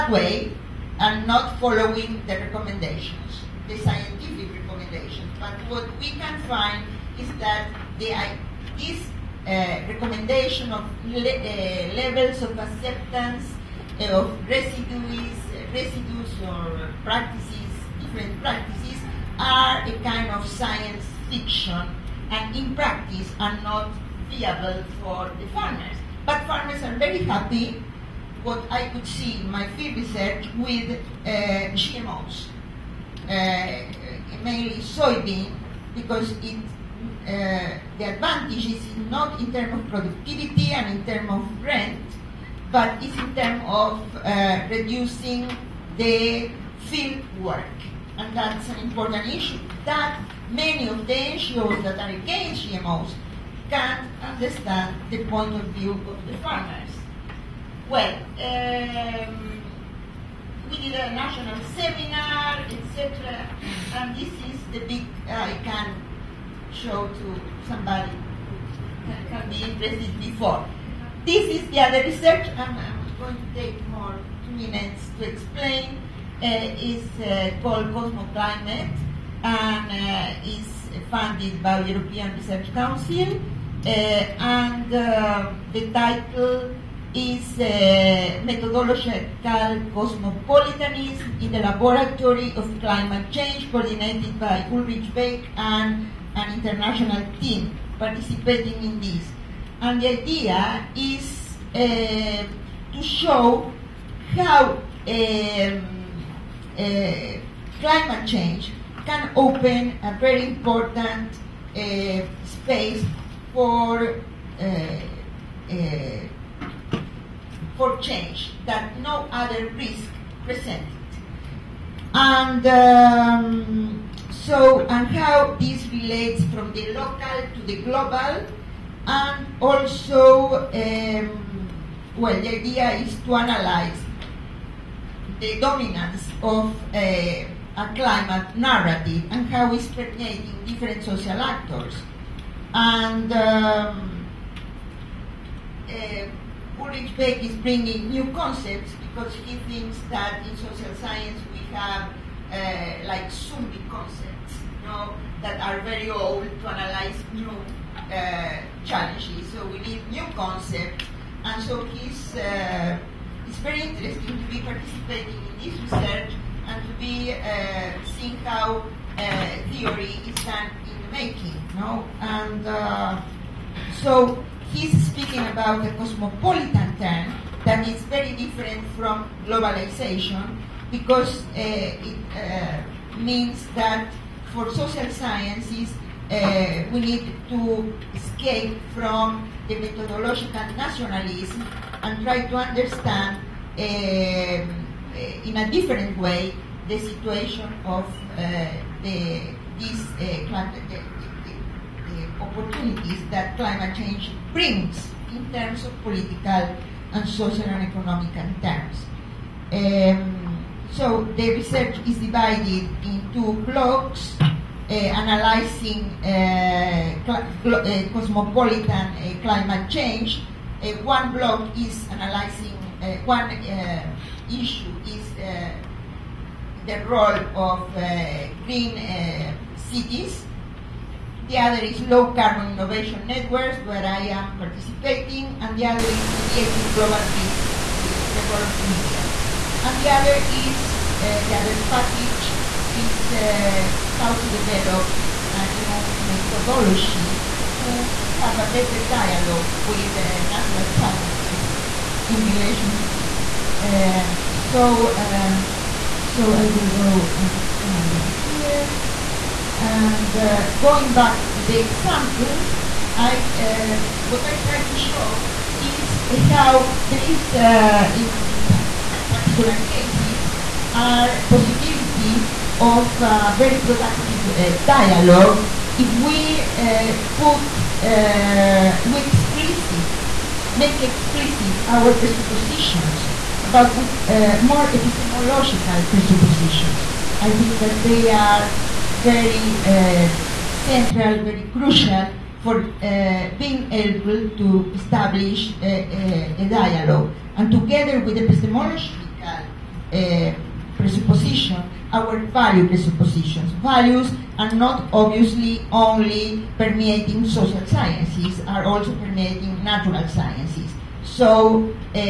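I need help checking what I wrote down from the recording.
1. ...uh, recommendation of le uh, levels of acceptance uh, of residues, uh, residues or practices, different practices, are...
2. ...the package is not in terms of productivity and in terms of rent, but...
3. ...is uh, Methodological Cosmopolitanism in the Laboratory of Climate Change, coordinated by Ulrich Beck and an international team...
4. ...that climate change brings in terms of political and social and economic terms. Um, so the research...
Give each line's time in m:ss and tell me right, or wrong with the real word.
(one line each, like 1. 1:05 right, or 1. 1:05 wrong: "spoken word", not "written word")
1. 0:09 right
2. 0:37 wrong: "advantage", not "package"
3. 1:27 right
4. 3:23 right.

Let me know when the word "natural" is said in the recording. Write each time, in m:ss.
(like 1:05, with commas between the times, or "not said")
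4:10, 5:09.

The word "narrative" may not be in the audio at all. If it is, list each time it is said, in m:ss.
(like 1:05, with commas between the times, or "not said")
2:18.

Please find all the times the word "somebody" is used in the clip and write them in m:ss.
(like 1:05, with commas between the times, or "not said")
1:07.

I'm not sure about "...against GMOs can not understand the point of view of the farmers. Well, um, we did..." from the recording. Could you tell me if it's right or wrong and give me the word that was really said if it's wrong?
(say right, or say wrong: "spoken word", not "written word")
right.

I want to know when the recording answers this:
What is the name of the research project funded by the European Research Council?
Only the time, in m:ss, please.
1:17.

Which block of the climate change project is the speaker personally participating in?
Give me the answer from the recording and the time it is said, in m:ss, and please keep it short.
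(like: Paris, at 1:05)
Low Carbon Innovation Networks, at 3:52.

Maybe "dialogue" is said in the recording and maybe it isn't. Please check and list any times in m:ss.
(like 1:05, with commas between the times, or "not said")
4:09, 4:34, 4:56.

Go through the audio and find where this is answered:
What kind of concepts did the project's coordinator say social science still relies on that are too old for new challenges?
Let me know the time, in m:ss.
2:33.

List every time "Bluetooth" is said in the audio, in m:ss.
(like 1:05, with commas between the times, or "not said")
not said.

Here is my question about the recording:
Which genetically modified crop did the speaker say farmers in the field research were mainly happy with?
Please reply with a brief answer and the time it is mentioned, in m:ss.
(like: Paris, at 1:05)
Soybean, at 0:34.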